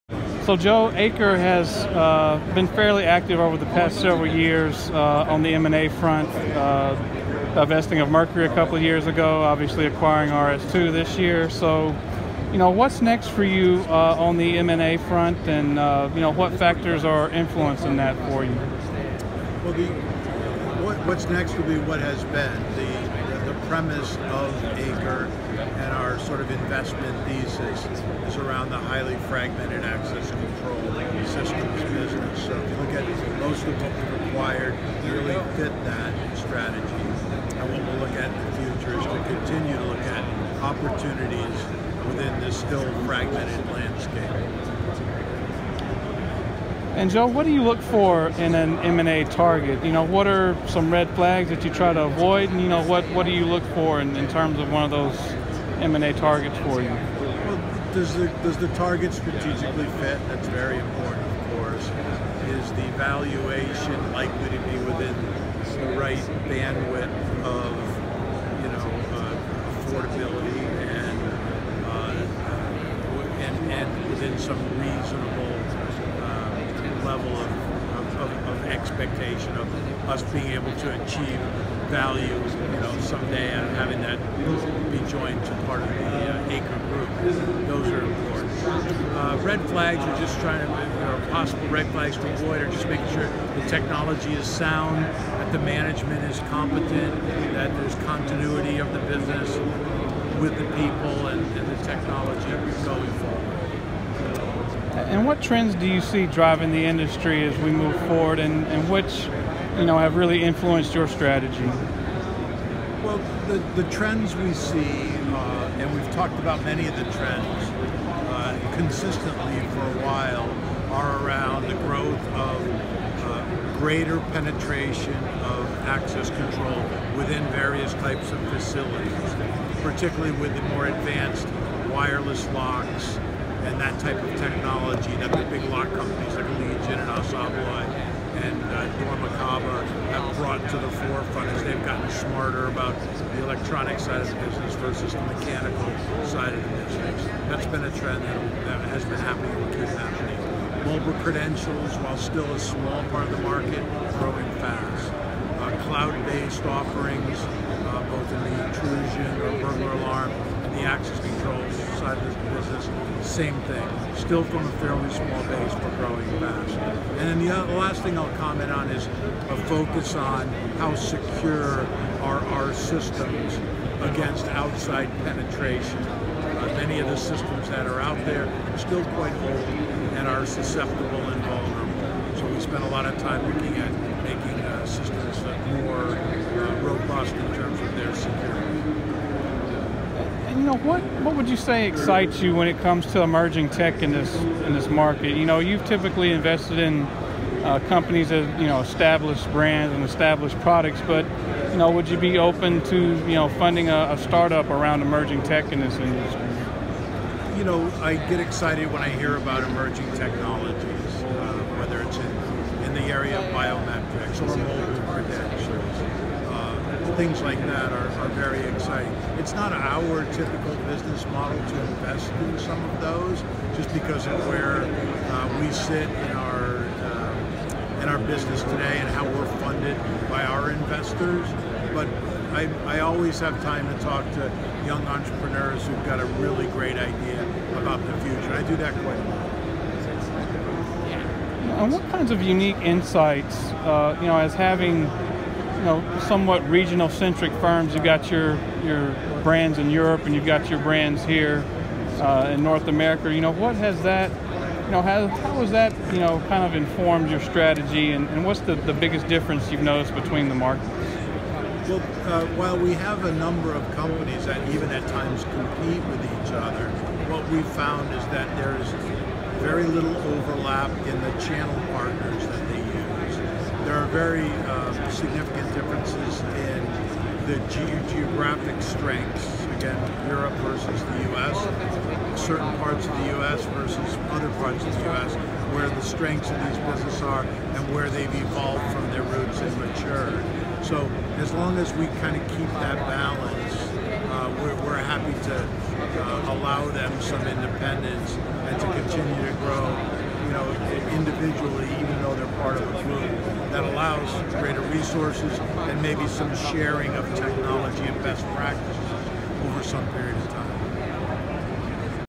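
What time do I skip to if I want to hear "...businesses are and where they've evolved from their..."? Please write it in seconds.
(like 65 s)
286 s.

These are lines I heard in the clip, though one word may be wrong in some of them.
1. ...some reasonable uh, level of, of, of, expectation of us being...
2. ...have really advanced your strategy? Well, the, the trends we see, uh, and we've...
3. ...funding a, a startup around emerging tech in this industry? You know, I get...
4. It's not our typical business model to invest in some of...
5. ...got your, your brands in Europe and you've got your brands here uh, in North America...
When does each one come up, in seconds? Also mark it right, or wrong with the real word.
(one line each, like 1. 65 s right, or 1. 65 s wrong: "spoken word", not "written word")
1. 74 s right
2. 109 s wrong: "influenced", not "advanced"
3. 203 s right
4. 219 s right
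5. 248 s right.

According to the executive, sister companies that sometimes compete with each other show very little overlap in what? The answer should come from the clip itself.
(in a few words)
channel partners.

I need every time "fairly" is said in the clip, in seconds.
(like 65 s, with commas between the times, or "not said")
2 s, 164 s.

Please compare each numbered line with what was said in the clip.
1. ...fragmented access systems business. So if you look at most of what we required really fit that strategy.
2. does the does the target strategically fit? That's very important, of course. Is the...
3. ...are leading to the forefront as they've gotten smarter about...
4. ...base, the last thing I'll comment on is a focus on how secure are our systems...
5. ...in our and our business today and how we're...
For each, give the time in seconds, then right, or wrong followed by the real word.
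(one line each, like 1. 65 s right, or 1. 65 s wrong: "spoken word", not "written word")
1. 29 s right
2. 57 s right
3. 136 s right
4. 165 s right
5. 226 s right.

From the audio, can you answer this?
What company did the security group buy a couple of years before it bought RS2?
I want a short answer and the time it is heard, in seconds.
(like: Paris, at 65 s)
Mercury, at 8 s.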